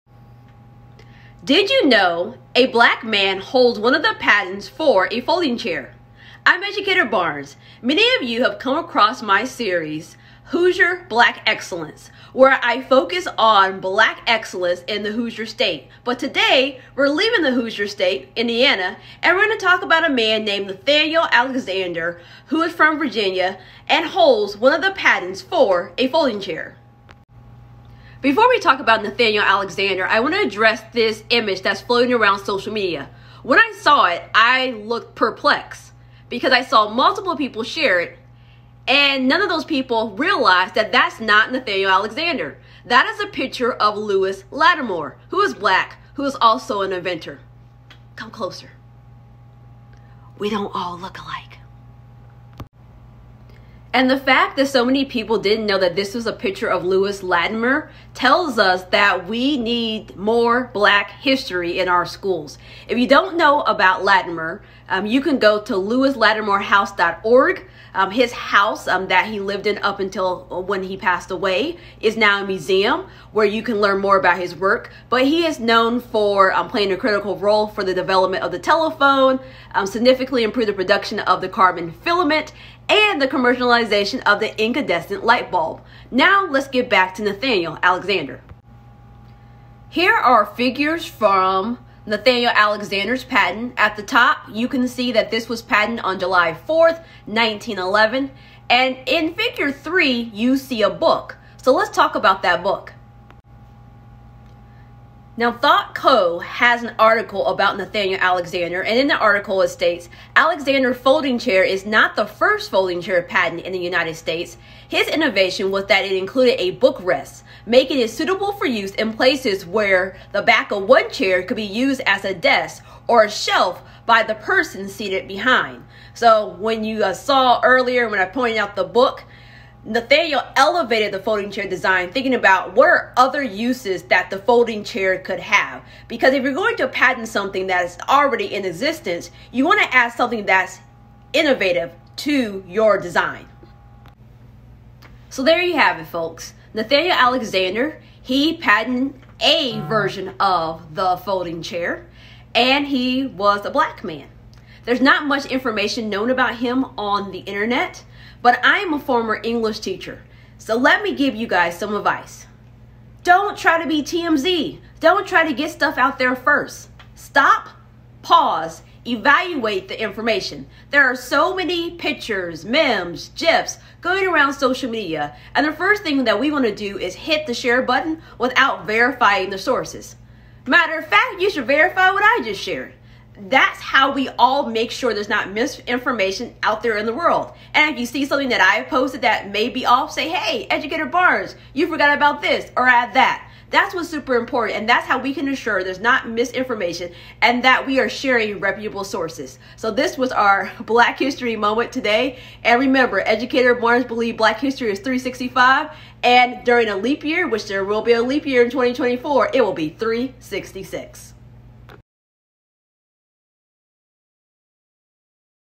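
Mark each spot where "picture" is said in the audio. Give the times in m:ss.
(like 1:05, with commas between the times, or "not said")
0:43, 0:56, 2:51.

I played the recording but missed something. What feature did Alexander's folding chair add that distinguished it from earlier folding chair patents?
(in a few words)
A bookrest.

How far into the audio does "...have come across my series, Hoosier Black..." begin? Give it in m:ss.
0:08.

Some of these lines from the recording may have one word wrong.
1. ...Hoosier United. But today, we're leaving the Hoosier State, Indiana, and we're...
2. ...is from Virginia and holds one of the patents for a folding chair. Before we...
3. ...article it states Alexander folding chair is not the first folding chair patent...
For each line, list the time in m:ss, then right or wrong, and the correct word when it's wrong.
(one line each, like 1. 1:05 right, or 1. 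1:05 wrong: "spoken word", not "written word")
1. 0:15 wrong: "State", not "United"
2. 0:22 right
3. 1:49 right.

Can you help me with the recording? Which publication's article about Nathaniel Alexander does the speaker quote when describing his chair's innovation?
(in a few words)
ThoughtCo.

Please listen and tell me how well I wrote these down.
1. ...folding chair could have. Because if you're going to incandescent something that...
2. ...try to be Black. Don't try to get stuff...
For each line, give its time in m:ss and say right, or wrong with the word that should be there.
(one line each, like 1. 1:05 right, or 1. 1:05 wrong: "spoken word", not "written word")
1. 2:14 wrong: "patent", not "incandescent"
2. 2:43 wrong: "TMZ", not "Black".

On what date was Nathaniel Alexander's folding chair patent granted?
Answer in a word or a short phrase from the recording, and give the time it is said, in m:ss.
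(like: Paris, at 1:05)
July 4th, 1911, at 1:36.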